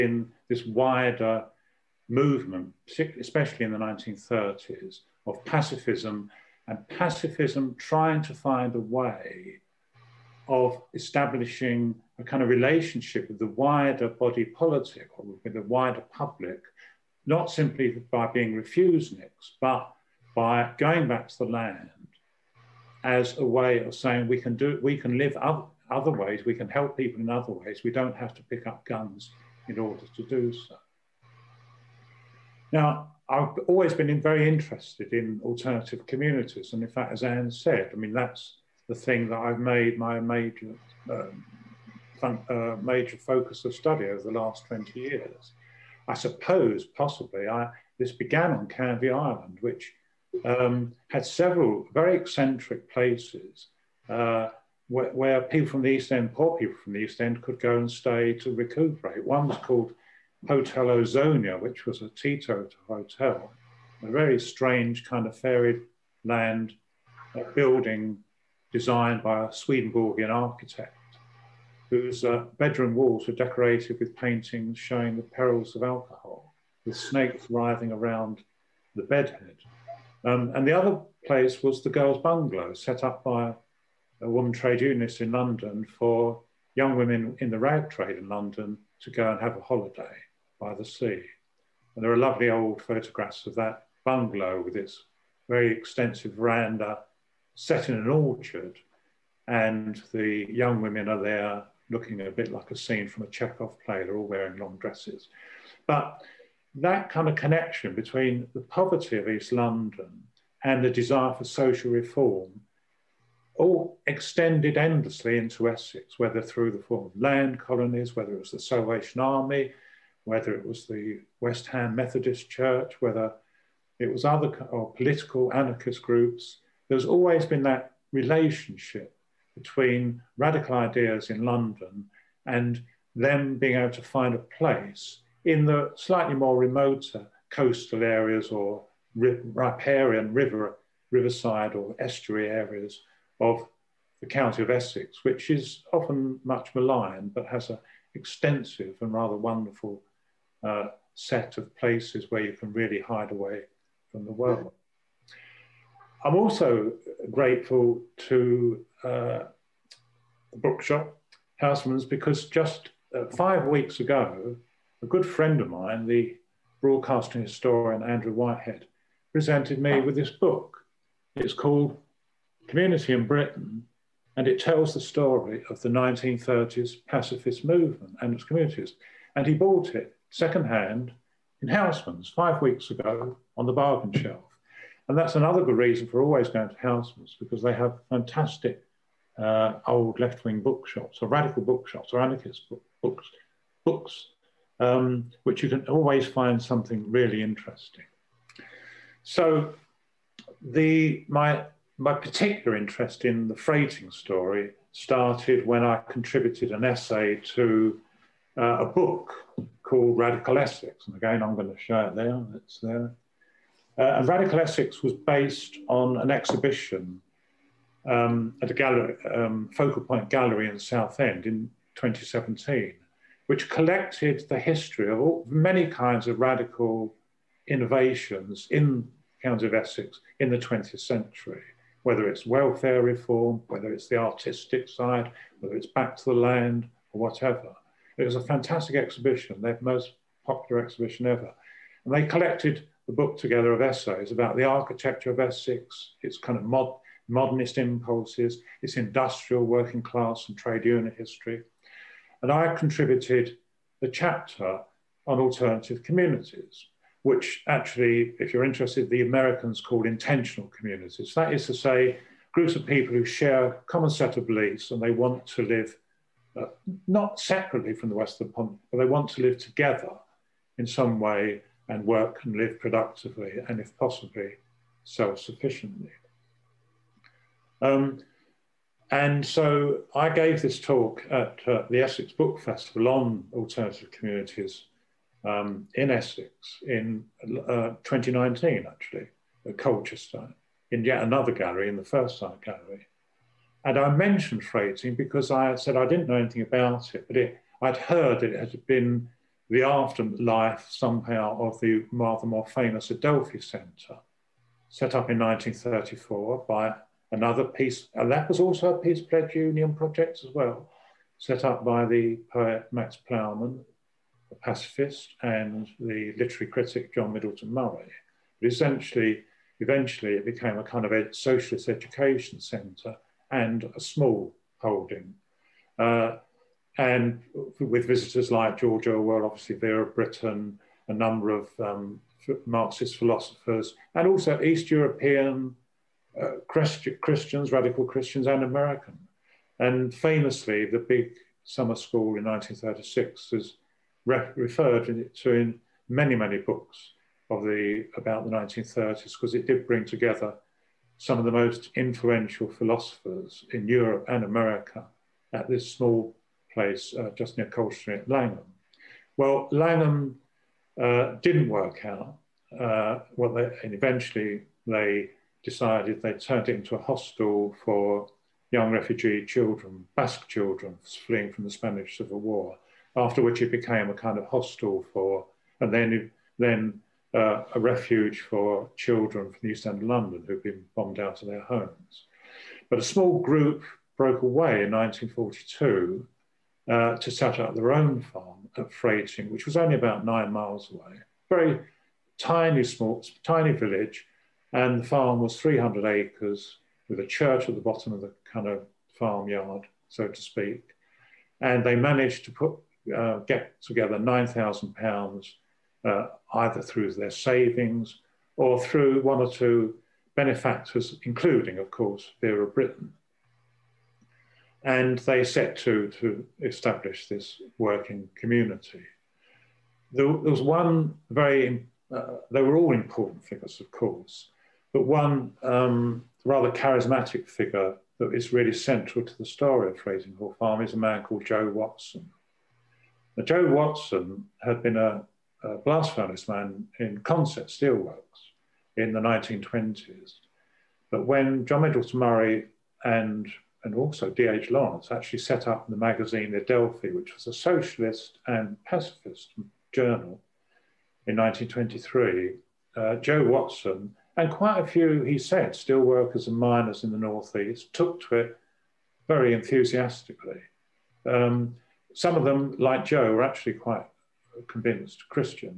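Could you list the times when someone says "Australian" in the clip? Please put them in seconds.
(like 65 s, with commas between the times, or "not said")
not said.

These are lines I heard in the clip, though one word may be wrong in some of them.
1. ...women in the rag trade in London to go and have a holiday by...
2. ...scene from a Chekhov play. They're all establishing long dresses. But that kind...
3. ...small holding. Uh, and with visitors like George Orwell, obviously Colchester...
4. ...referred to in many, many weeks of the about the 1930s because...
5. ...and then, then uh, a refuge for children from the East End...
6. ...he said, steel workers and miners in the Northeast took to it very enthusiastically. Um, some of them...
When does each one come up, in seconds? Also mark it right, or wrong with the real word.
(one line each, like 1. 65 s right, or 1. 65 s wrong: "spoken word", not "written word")
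1. 86 s right
2. 102 s wrong: "wearing", not "establishing"
3. 324 s wrong: "Vera", not "Colchester"
4. 344 s wrong: "books", not "weeks"
5. 375 s right
6. 455 s right.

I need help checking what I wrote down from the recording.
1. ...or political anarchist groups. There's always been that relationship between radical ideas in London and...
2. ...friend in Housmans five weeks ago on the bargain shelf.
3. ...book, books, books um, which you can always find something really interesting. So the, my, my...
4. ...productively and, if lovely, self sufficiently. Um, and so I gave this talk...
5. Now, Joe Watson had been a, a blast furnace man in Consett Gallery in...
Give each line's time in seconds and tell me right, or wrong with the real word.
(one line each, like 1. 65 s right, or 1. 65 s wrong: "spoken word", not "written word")
1. 124 s right
2. 180 s wrong: "secondhand", not "friend"
3. 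192 s right
4. 272 s wrong: "possibly", not "lovely"
5. 433 s wrong: "Steelworks", not "Gallery".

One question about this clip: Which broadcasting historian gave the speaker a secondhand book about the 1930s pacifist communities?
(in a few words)
Andrew Whitehead.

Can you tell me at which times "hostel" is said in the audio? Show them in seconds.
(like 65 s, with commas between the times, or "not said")
367 s, 374 s.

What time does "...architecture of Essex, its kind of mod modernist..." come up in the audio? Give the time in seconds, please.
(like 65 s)
244 s.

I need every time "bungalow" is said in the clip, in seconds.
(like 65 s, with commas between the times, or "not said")
82 s, 94 s.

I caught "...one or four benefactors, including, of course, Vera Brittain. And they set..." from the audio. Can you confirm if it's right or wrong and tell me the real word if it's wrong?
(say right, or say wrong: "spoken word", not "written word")
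wrong: "two", not "four".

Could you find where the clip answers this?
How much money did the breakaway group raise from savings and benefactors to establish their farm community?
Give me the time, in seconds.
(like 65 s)
404 s.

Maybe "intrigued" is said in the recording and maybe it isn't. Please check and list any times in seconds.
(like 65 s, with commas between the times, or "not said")
not said.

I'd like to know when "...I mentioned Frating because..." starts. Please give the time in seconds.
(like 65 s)
293 s.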